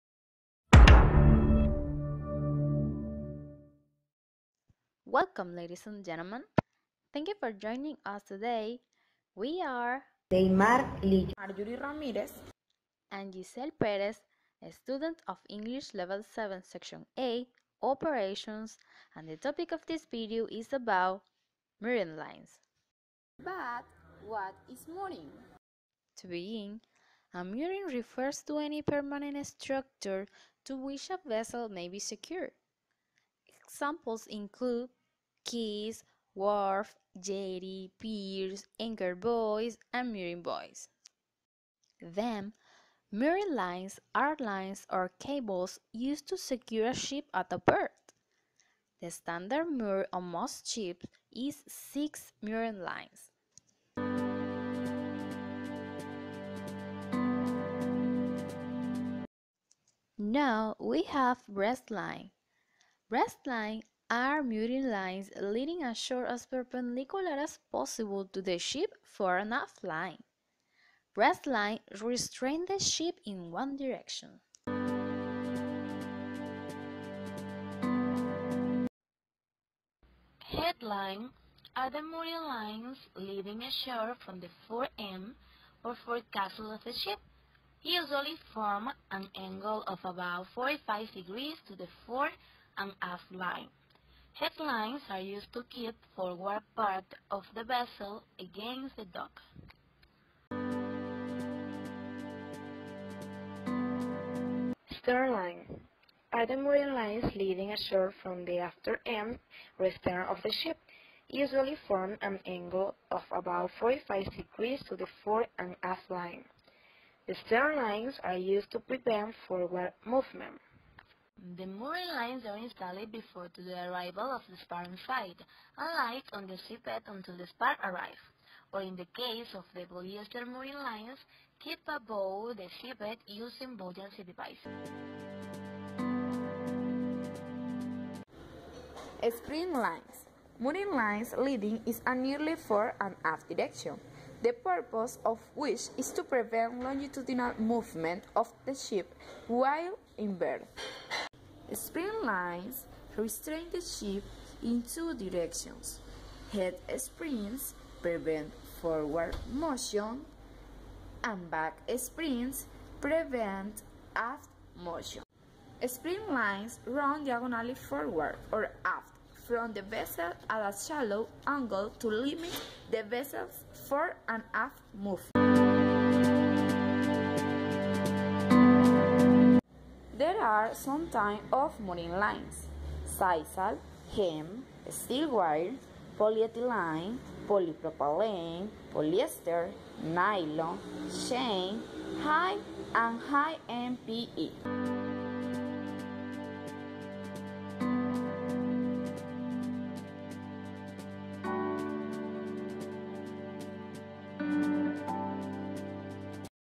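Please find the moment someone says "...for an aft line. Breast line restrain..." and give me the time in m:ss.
1:09.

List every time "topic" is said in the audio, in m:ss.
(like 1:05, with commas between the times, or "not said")
0:19.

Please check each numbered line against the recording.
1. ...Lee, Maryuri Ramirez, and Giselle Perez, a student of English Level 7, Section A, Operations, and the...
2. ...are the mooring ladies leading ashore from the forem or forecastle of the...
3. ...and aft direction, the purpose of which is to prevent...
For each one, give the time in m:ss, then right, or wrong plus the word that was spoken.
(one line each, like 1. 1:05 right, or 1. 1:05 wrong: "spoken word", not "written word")
1. 0:11 right
2. 1:21 wrong: "lines", not "ladies"
3. 2:22 right.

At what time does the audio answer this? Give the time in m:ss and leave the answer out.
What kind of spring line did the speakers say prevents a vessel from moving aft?
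2:41.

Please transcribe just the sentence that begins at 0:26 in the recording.
To begin, a mooring refers to any permanent structure to which a vessel may be secured.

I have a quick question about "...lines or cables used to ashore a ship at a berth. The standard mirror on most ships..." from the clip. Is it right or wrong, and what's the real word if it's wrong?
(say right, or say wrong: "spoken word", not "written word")
wrong: "secure", not "ashore".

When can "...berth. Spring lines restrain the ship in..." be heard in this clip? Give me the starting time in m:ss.
2:30.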